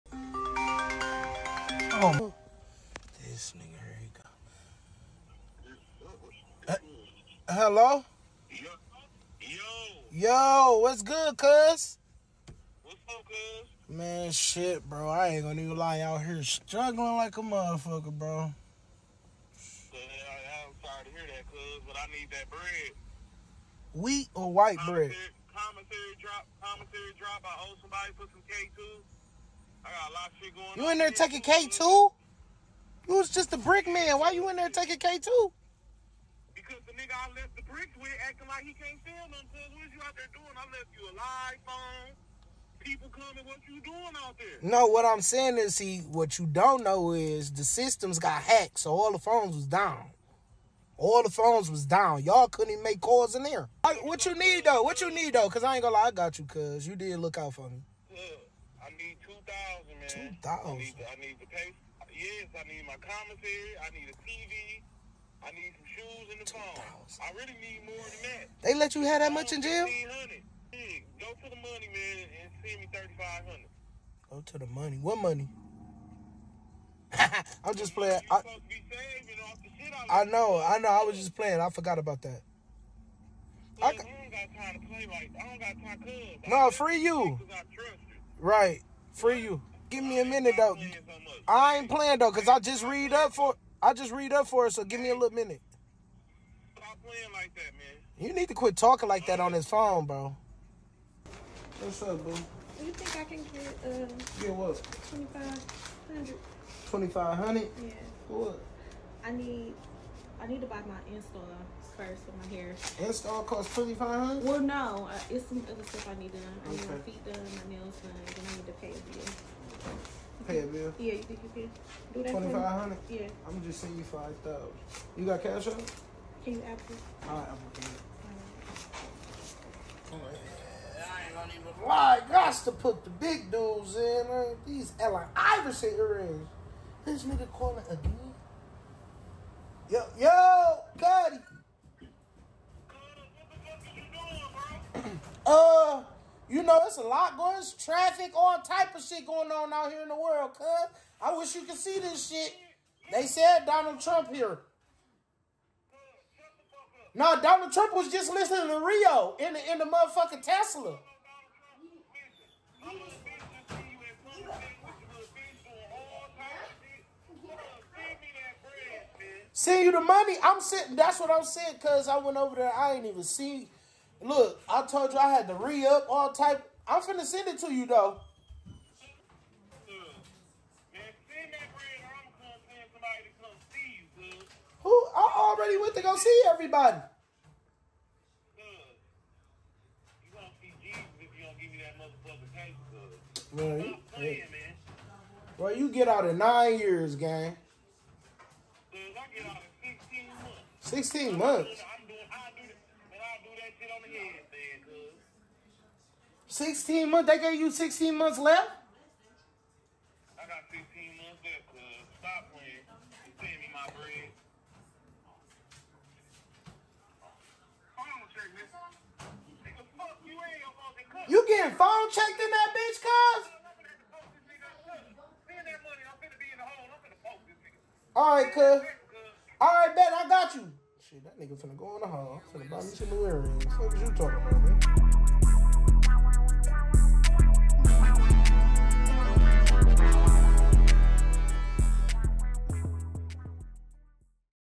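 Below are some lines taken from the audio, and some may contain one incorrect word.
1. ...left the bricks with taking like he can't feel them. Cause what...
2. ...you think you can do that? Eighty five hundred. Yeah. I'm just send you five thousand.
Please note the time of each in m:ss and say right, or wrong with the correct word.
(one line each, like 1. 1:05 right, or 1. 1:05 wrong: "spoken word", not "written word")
1. 0:37 wrong: "acting", not "taking"
2. 2:01 wrong: "Twenty", not "Eighty".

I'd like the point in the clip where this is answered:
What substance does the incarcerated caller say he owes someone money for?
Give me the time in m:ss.
0:28.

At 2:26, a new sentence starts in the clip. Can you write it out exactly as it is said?
You know, it's a lot going, it's traffic, all type of shit going on out here in the world, cuz.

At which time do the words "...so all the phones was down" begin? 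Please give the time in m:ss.
0:48.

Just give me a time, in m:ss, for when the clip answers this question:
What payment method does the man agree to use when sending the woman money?
2:07.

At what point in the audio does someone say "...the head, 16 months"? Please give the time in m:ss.
3:24.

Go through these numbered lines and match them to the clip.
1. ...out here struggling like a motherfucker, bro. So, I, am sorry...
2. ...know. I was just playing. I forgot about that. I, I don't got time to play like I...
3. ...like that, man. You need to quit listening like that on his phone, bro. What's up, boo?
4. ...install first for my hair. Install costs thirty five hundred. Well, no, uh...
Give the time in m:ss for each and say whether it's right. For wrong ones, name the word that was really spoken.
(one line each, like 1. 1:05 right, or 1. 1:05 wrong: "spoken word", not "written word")
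1. 0:15 right
2. 1:20 right
3. 1:37 wrong: "talking", not "listening"
4. 1:51 wrong: "twenty", not "thirty".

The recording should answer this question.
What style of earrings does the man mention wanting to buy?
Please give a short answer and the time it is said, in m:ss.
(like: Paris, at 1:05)
Allen Iverson earrings, at 2:14.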